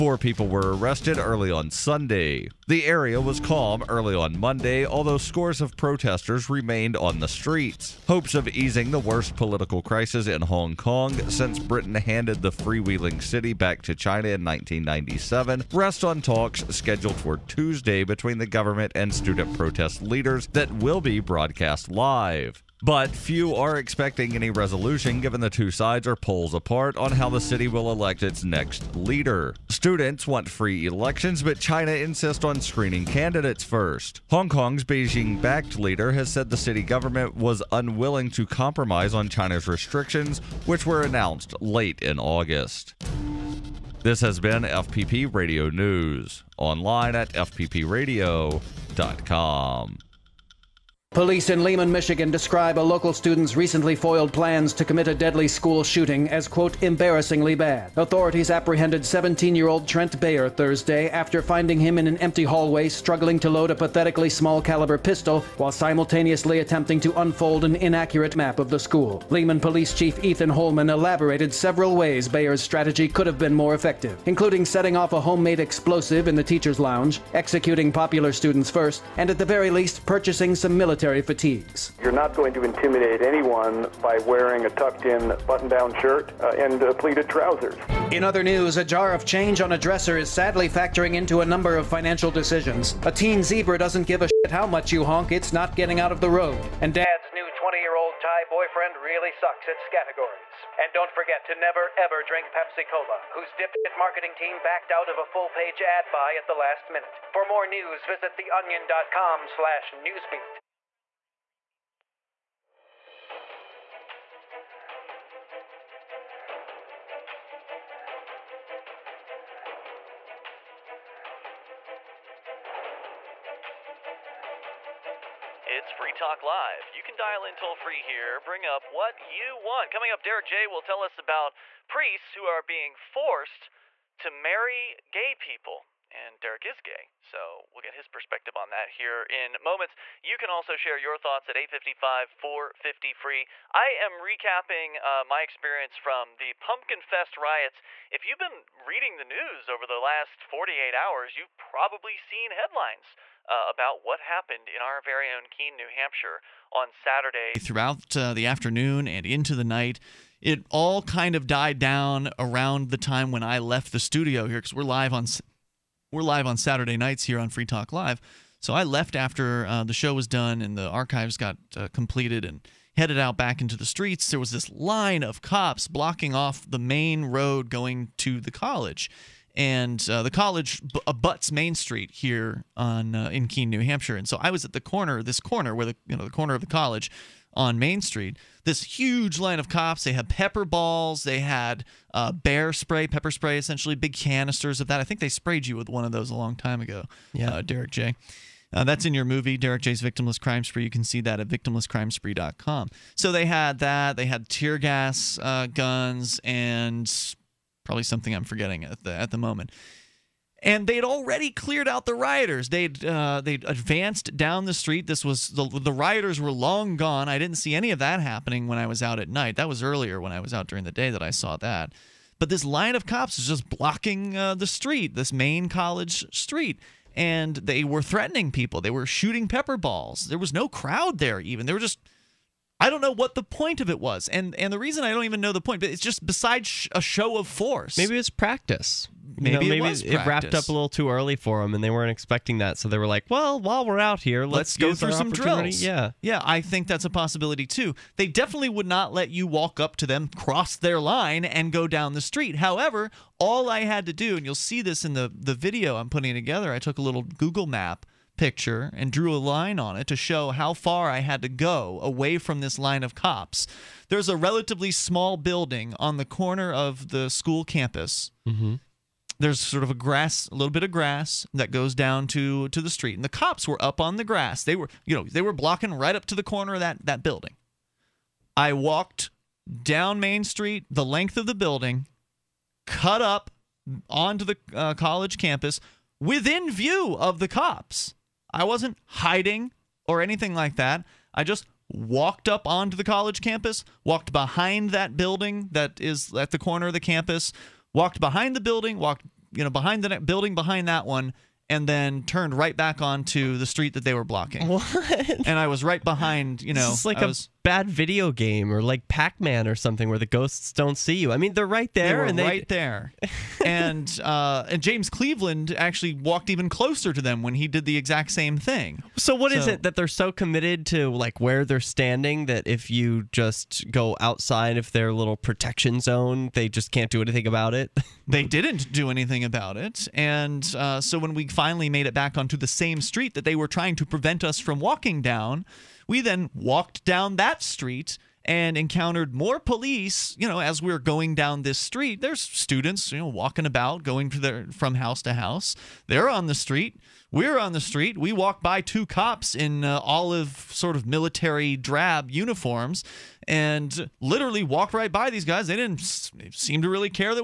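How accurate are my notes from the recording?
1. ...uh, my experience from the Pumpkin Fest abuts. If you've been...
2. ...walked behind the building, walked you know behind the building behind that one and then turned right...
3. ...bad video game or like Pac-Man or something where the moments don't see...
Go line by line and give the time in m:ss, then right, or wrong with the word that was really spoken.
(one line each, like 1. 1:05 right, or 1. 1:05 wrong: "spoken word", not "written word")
1. 2:25 wrong: "riots", not "abuts"
2. 4:57 right
3. 5:07 wrong: "ghosts", not "moments".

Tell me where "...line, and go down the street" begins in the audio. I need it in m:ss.
4:10.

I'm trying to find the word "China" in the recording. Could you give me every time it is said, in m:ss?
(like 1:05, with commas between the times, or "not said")
0:13, 0:31, 0:39.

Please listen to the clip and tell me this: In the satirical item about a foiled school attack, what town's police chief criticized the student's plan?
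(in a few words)
Lehman, Michigan.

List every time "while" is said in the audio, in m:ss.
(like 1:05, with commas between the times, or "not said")
1:05, 4:03.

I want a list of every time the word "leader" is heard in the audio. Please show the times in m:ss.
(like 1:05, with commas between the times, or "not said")
0:20, 0:28, 0:35.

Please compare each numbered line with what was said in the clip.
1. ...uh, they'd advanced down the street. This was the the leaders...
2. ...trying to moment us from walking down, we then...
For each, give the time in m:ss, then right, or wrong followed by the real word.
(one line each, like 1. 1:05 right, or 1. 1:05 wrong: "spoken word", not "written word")
1. 3:33 wrong: "rioters", not "leaders"
2. 5:33 wrong: "prevent", not "moment".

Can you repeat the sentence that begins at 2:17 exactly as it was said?
So we'll get his perspective on that here in moments.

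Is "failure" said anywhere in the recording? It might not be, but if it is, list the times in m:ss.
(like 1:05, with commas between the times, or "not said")
not said.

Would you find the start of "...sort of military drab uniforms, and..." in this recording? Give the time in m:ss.
5:50.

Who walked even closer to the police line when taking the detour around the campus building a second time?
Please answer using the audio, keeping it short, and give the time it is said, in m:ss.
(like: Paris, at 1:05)
James Cleveland, at 5:14.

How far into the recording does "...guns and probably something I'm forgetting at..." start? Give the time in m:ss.
3:25.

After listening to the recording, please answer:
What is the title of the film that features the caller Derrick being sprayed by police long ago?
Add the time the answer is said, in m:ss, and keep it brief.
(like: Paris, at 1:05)
Victimless Crime Spree, at 3:20.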